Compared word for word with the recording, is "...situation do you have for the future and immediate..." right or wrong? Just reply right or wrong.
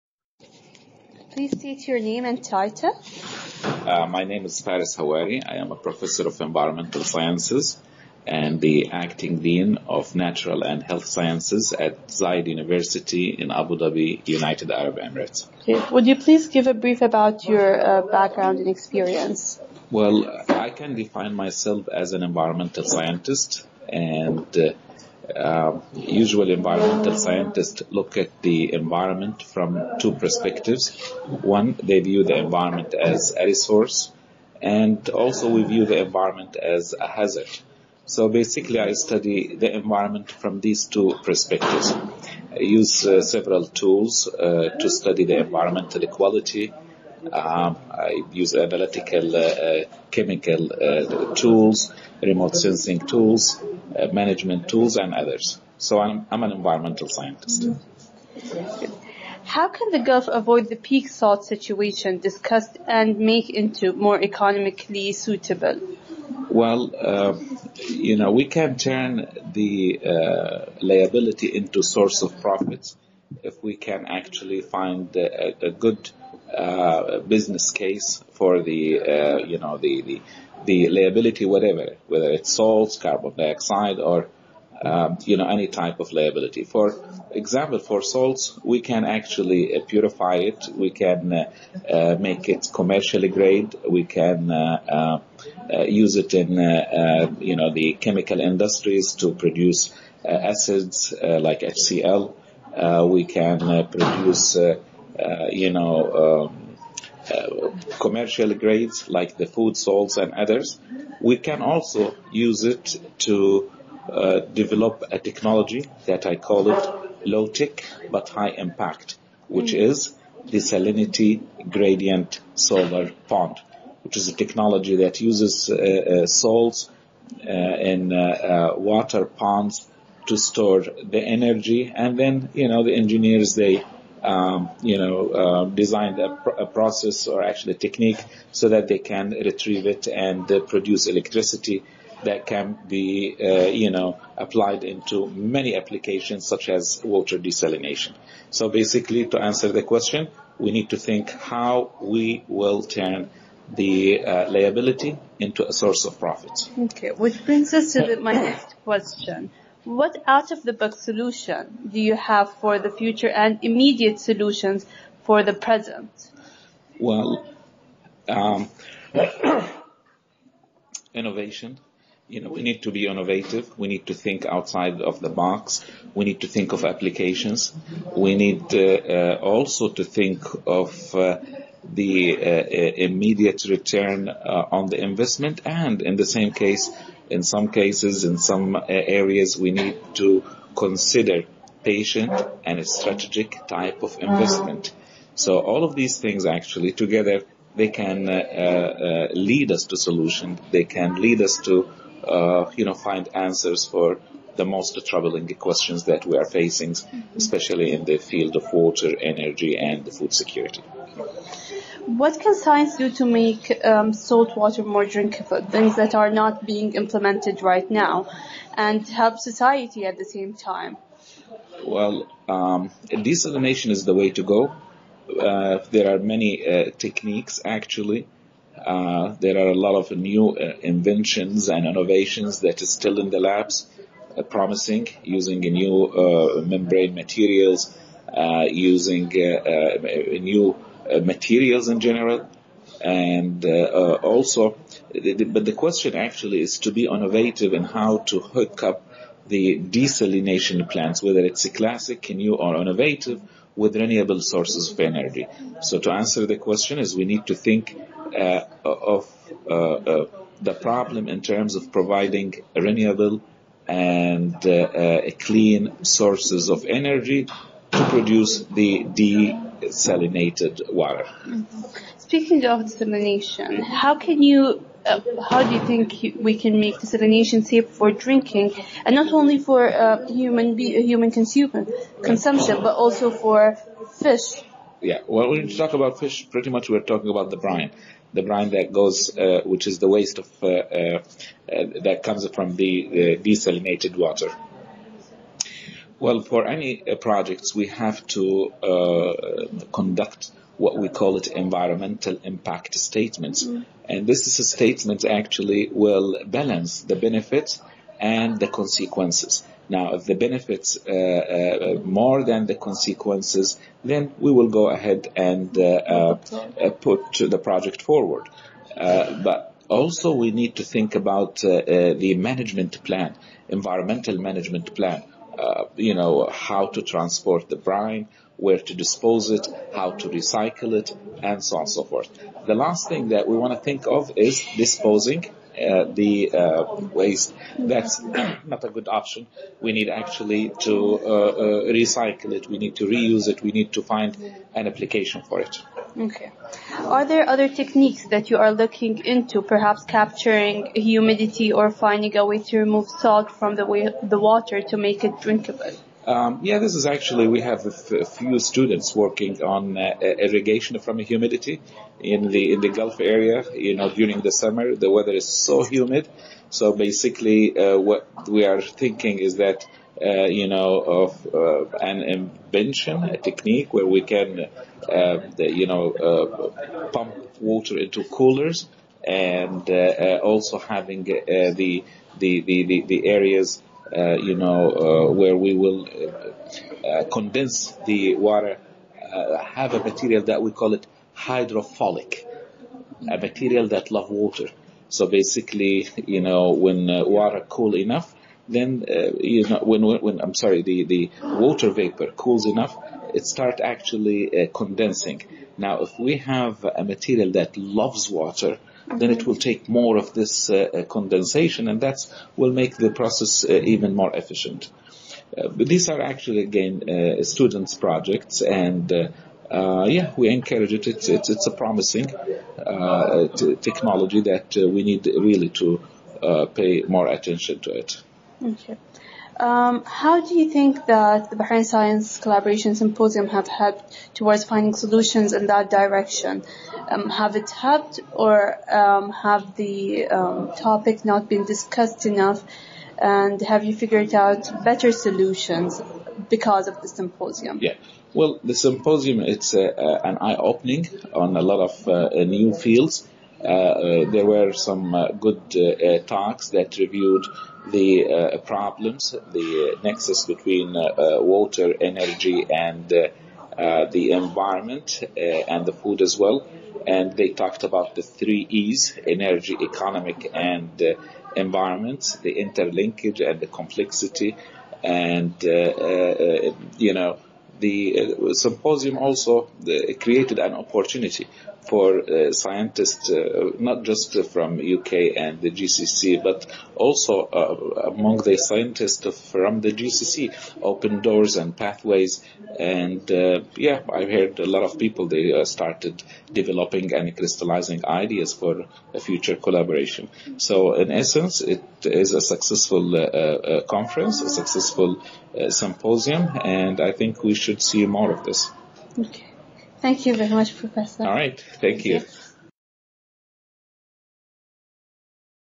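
wrong.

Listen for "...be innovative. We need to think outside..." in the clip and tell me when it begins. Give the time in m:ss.
2:52.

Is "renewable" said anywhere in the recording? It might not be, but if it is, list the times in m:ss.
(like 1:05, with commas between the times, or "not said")
4:13, 4:22.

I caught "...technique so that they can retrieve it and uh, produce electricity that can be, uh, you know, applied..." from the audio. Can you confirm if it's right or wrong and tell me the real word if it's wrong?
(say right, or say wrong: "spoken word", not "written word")
right.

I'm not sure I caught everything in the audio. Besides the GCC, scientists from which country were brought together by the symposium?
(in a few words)
UK.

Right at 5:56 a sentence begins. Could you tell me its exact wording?
Um, yeah, this is actually, we have a few students working on uh, irrigation from humidity in the, in the Gulf area.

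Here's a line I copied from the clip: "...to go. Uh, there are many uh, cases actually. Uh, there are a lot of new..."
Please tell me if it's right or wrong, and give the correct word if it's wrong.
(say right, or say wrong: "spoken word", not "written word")
wrong: "techniques", not "cases".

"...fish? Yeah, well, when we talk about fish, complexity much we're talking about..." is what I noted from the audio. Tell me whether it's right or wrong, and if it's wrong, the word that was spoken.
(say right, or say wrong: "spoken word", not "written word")
wrong: "pretty", not "complexity".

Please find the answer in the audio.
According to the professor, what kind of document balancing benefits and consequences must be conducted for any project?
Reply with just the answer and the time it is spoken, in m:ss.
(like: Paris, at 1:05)
Environmental impact statements, at 5:01.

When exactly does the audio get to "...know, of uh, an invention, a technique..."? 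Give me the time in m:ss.
6:10.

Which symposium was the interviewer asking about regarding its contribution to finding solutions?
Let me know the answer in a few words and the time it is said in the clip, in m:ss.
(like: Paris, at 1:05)
Bahrain Science Collaboration Symposium, at 7:11.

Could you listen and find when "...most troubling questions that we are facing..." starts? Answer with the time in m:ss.
3:24.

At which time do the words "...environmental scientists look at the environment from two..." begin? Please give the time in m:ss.
0:26.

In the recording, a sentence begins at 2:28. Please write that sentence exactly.
So basically, to answer the question, we need to think how we will turn the uh, liability into a source of profit.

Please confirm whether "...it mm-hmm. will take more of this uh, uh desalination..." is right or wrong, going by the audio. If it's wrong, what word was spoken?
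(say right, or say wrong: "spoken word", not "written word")
wrong: "condensation", not "desalination".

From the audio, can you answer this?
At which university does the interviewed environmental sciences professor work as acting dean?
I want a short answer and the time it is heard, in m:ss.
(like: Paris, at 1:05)
Zayed University, at 0:12.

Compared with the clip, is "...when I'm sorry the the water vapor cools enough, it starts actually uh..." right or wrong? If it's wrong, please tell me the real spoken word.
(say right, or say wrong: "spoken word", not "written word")
right.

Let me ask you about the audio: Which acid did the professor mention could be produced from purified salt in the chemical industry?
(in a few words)
HCl.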